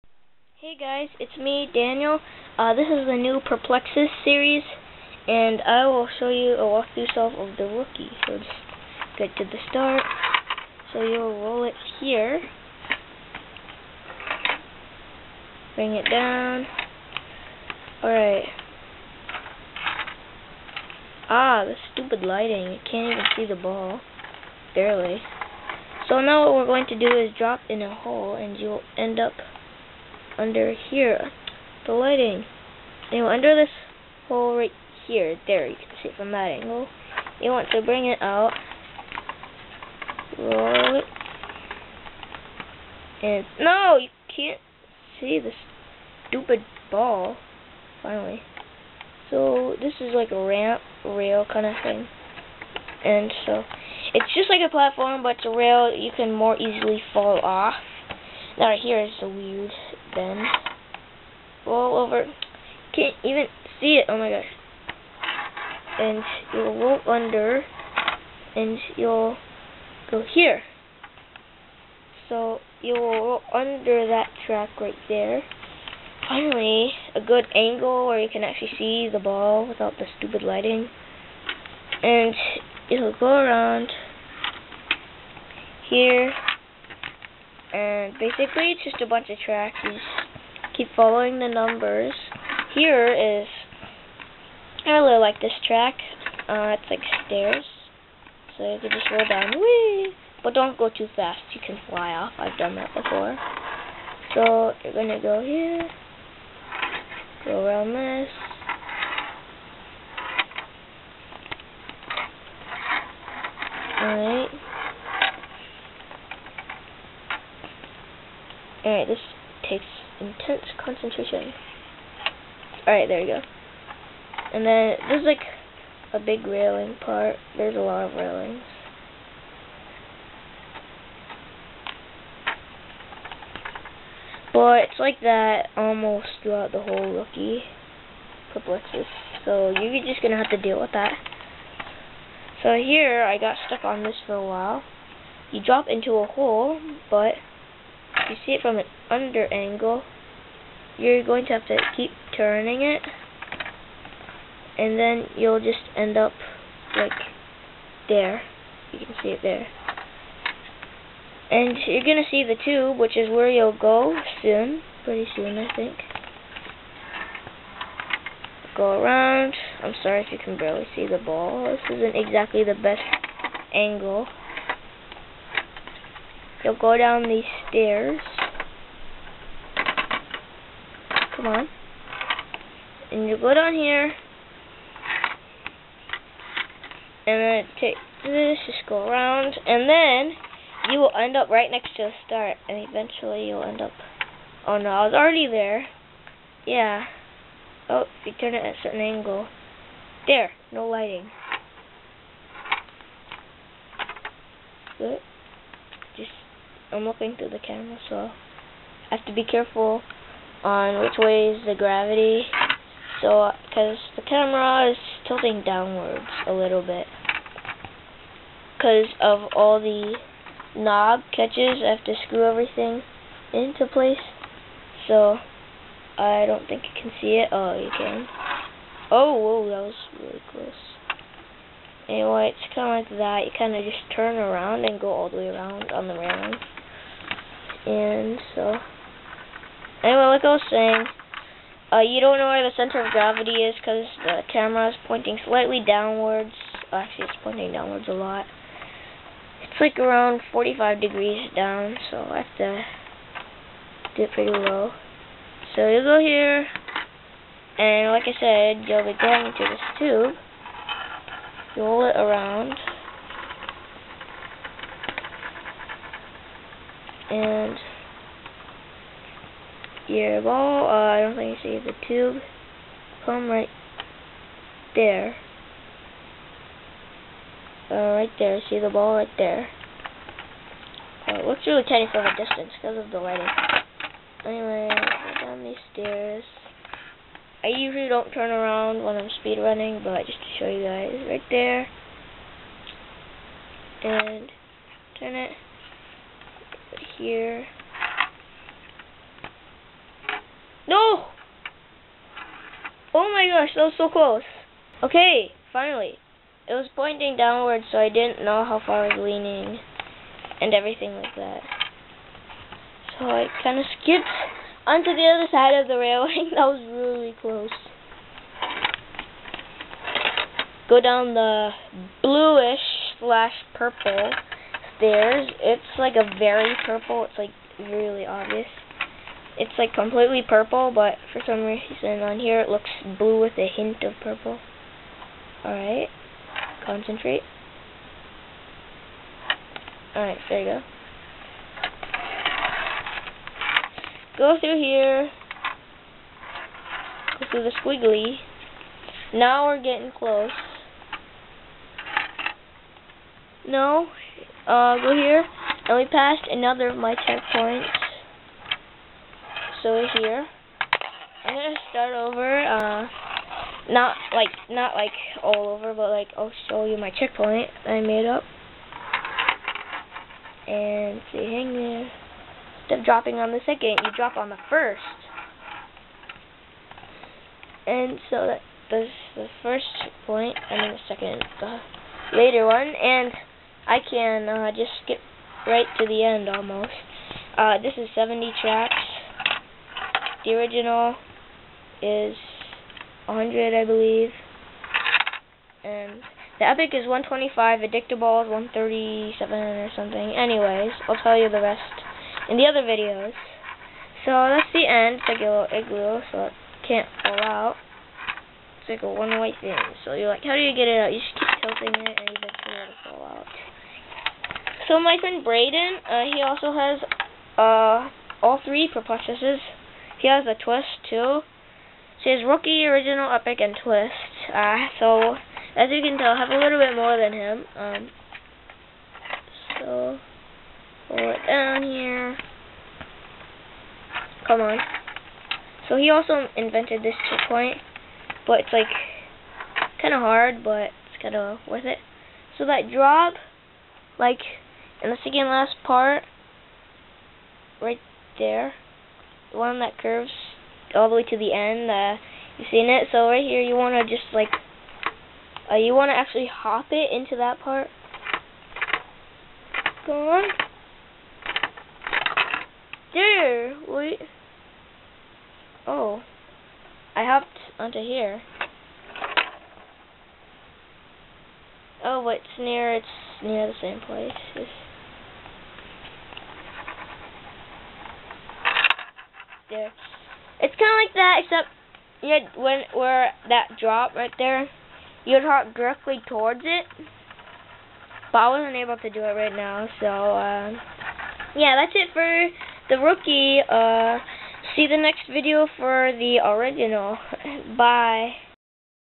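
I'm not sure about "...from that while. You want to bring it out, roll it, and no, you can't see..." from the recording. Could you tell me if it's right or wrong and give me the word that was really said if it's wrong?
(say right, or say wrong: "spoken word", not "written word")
wrong: "angle", not "while".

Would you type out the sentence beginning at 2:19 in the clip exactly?
So you're just gonna have to deal with that.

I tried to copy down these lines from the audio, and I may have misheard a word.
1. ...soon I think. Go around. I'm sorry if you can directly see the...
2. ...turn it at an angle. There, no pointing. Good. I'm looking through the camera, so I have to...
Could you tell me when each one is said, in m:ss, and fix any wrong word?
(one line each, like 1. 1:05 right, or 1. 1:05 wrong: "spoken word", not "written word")
1. 2:45 wrong: "barely", not "directly"
2. 3:18 wrong: "lighting", not "pointing".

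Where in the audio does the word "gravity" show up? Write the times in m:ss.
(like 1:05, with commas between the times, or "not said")
3:31, 4:03.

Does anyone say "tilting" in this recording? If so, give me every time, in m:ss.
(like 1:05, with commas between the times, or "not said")
3:35, 6:51.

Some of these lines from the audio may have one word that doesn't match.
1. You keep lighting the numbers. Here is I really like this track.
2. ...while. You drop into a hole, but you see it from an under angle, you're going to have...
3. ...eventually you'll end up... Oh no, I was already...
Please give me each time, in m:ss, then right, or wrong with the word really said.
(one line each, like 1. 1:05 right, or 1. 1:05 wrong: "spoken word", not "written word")
1. 1:29 wrong: "following", not "lighting"
2. 2:24 right
3. 3:12 right.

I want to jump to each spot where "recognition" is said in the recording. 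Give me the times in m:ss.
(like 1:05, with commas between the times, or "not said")
not said.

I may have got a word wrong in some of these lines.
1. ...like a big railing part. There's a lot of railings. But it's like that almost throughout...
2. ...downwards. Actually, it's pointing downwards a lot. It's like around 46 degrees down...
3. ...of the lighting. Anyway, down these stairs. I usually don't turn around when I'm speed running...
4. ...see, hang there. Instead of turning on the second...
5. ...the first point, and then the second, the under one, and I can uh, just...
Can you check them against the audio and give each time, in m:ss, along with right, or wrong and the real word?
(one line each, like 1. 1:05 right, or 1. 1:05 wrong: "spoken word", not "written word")
1. 2:05 right
2. 4:05 wrong: "45", not "46"
3. 4:43 right
4. 6:11 wrong: "dropping", not "turning"
5. 6:19 wrong: "later", not "under".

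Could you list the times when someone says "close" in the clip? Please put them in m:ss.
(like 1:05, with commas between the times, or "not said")
3:50, 5:04, 5:17, 5:50.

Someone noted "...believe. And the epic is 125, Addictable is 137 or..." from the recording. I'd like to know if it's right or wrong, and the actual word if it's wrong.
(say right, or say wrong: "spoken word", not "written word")
right.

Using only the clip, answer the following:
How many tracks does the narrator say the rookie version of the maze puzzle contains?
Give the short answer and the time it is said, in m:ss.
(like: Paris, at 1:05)
70, at 6:28.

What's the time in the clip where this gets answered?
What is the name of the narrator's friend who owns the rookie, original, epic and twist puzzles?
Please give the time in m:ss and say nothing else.
6:55.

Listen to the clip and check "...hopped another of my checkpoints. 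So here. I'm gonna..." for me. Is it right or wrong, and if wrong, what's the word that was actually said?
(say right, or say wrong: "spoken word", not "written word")
wrong: "passed", not "hopped".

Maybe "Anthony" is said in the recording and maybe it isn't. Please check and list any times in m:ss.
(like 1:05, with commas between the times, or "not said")
not said.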